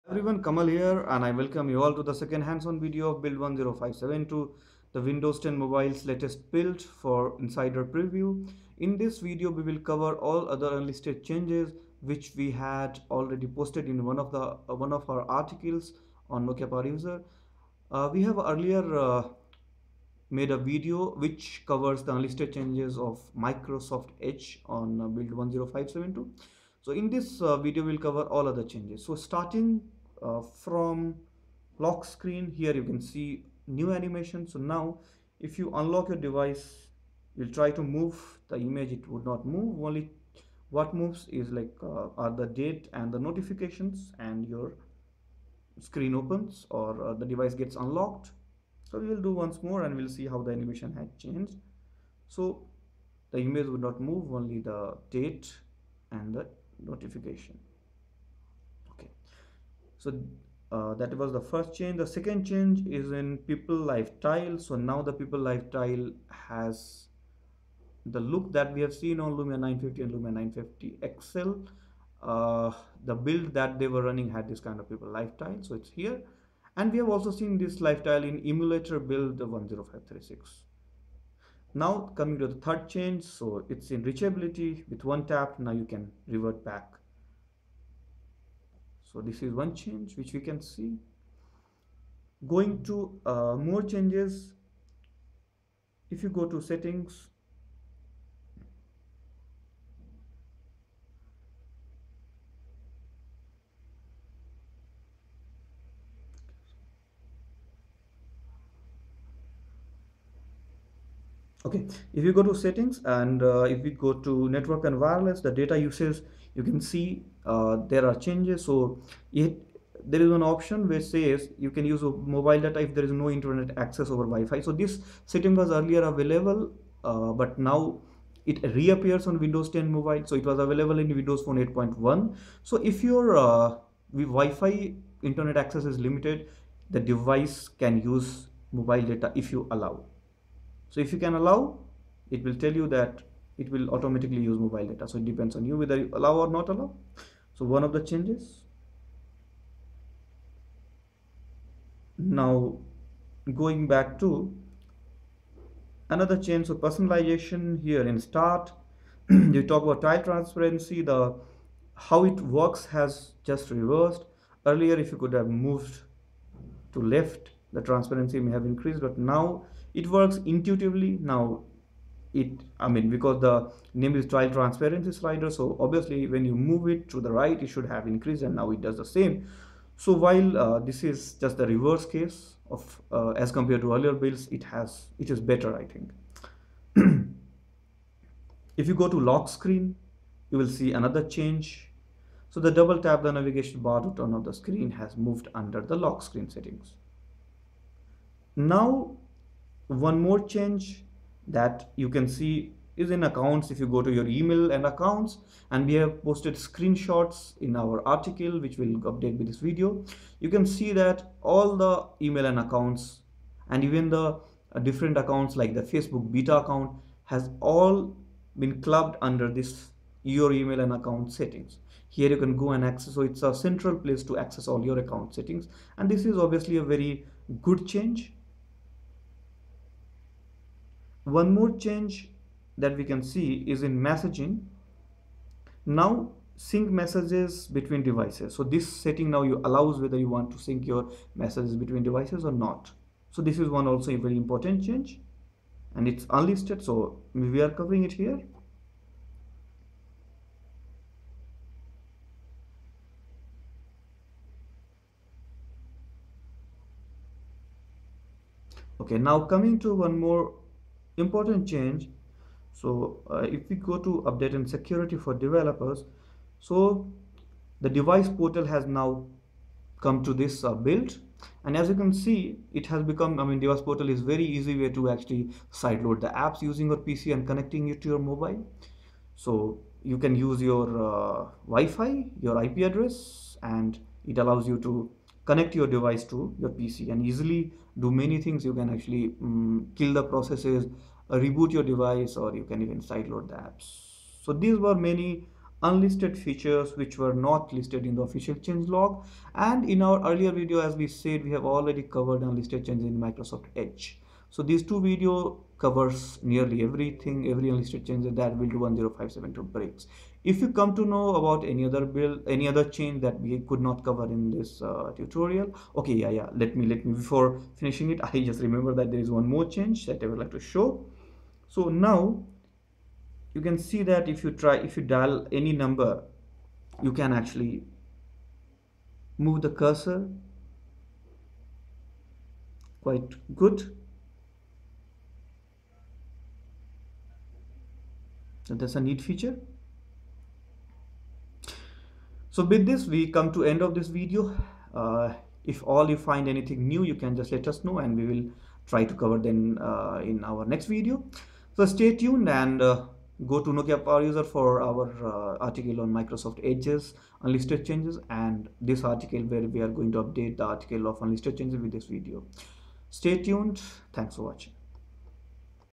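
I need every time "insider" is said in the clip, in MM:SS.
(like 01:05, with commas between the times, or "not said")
00:07.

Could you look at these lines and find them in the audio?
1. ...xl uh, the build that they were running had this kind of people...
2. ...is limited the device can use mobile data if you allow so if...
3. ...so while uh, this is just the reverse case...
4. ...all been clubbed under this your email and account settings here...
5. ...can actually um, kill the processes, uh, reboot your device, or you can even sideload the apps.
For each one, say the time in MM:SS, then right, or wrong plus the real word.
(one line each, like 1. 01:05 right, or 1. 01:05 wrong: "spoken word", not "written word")
1. 01:11 right
2. 02:15 right
3. 02:59 right
4. 03:37 right
5. 04:48 right.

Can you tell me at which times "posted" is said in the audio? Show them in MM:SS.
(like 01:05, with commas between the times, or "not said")
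00:13, 03:26.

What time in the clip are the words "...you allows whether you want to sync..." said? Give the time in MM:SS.
03:59.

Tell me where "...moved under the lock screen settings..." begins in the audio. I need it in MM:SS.
03:15.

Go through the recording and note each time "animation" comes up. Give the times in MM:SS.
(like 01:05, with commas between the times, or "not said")
00:33, 00:50.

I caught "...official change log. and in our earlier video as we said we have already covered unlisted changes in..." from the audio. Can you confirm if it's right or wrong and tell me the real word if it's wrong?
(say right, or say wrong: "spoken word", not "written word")
right.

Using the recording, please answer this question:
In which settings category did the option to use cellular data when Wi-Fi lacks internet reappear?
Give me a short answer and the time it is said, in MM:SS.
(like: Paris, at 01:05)
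network and wireless, at 01:54.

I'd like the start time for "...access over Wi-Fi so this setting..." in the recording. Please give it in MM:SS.
02:03.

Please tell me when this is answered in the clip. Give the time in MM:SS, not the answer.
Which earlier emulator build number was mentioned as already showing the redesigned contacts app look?
01:19.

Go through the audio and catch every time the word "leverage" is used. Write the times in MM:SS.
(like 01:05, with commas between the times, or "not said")
not said.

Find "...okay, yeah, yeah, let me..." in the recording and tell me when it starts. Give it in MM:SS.
05:15.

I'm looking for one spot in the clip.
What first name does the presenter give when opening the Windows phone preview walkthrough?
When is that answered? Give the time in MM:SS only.
00:00.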